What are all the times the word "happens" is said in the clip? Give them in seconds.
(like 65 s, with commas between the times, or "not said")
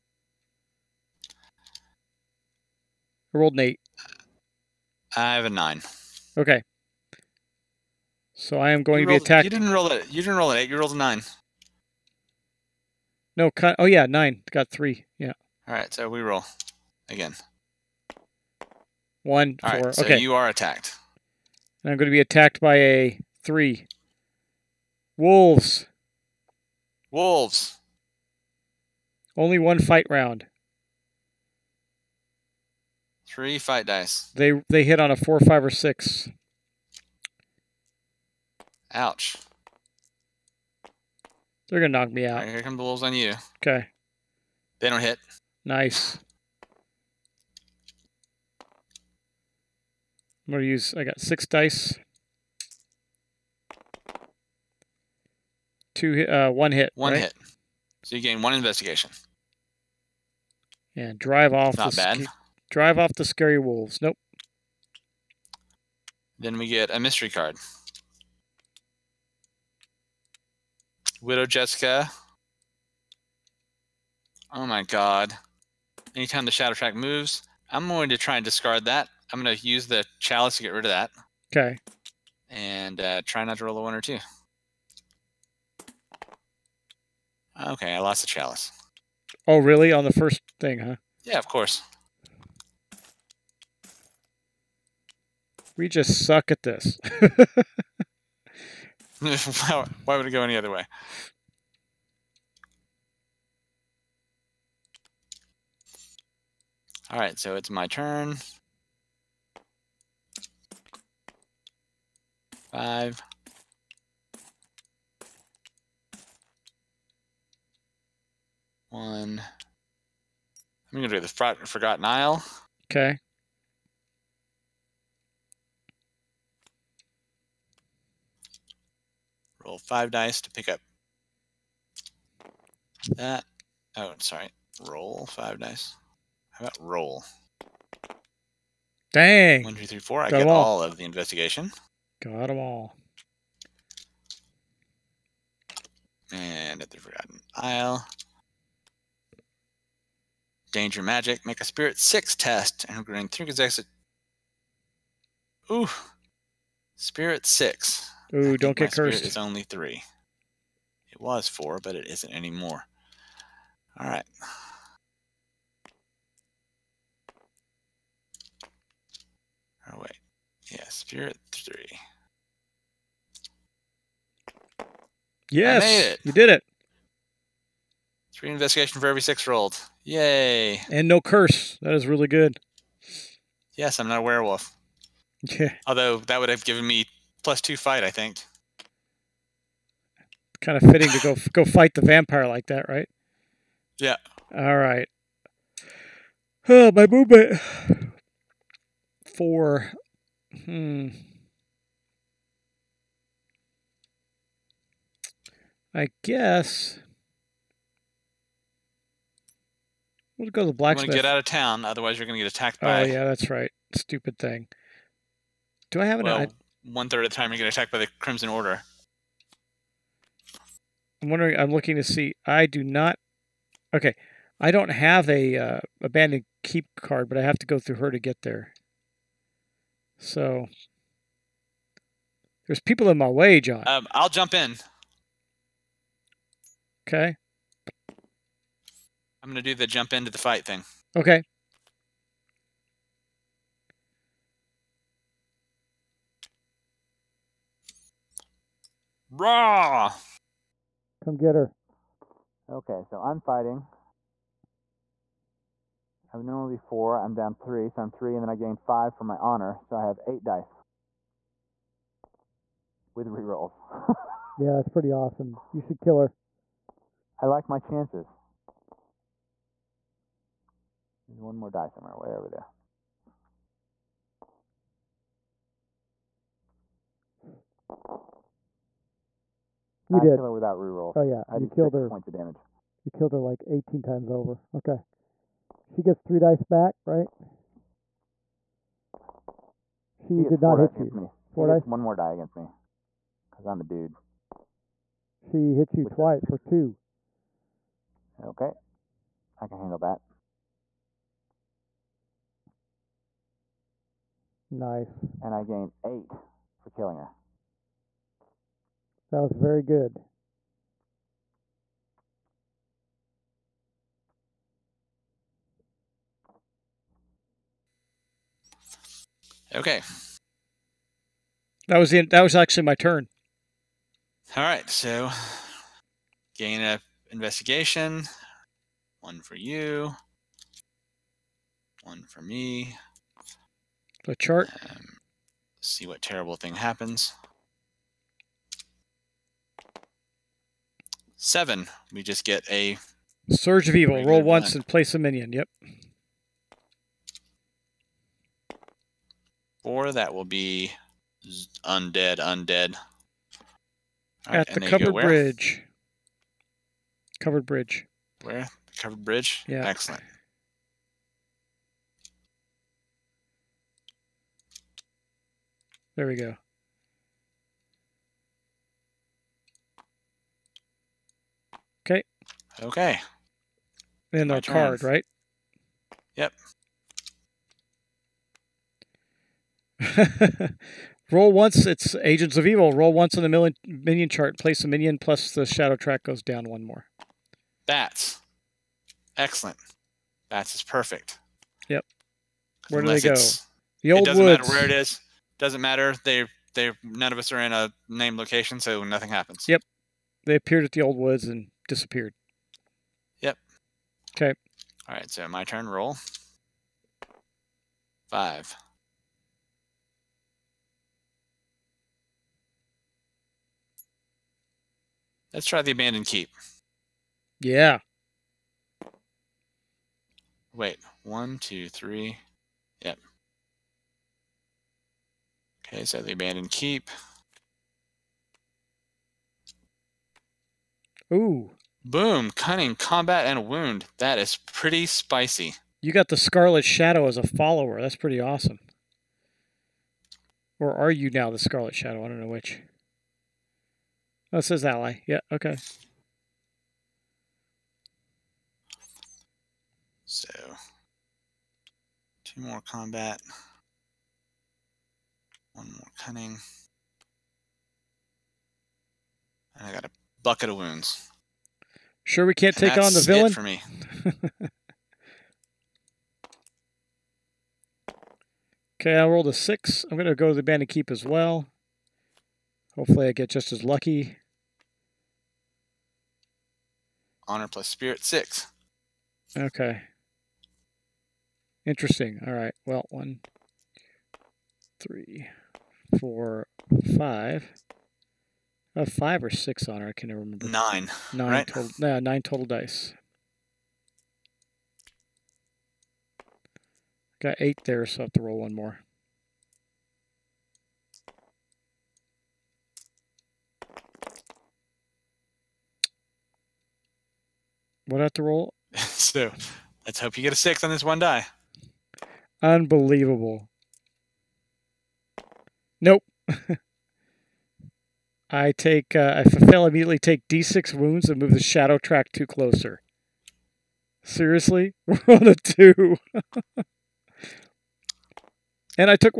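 336 s, 399 s.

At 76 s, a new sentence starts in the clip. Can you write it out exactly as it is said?
Anytime the Shadow Track moves, I'm going to try and discard that.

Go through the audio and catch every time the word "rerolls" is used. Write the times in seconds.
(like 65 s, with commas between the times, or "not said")
263 s, 280 s.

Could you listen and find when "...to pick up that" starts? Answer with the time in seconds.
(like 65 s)
130 s.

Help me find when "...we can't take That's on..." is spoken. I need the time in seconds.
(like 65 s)
462 s.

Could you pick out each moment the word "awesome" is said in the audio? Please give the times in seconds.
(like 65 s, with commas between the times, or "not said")
265 s, 438 s.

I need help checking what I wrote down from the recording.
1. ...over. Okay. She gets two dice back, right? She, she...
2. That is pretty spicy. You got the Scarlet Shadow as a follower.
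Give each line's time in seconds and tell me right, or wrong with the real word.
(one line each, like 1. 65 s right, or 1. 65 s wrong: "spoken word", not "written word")
1. 284 s wrong: "three", not "two"
2. 434 s right.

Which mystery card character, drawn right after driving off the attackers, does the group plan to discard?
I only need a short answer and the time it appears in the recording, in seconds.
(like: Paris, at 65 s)
Widow Jessica, at 71 s.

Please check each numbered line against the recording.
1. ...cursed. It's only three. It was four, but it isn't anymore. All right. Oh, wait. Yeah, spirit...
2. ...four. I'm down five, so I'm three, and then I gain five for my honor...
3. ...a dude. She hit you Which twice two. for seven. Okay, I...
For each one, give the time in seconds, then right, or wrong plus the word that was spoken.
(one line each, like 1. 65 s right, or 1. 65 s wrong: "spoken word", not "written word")
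1. 158 s right
2. 256 s wrong: "three", not "five"
3. 293 s wrong: "two", not "seven".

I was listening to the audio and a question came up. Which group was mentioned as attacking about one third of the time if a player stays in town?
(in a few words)
The Crimson Order.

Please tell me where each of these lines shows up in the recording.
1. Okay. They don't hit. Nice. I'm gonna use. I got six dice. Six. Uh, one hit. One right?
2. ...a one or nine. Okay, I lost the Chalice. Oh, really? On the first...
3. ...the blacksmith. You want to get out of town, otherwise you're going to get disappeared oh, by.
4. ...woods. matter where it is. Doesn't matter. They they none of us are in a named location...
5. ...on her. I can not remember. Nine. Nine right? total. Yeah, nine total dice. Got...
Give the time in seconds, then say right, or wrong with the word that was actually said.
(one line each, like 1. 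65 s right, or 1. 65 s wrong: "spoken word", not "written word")
1. 43 s wrong: "Two", not "Six"
2. 83 s wrong: "two", not "nine"
3. 210 s wrong: "attacked", not "disappeared"
4. 394 s right
5. 489 s right.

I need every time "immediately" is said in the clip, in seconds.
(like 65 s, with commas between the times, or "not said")
519 s.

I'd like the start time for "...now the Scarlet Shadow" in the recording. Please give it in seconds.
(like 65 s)
441 s.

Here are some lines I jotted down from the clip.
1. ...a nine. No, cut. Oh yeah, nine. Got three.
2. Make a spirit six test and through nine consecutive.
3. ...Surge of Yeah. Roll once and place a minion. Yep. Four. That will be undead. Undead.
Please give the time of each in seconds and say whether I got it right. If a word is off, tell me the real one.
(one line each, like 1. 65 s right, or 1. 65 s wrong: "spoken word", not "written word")
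1. 10 s right
2. 151 s wrong: "three", not "nine"
3. 343 s wrong: "Evil", not "Yeah".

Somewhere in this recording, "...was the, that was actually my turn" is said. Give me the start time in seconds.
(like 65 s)
321 s.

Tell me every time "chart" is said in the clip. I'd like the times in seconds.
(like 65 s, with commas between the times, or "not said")
334 s, 384 s.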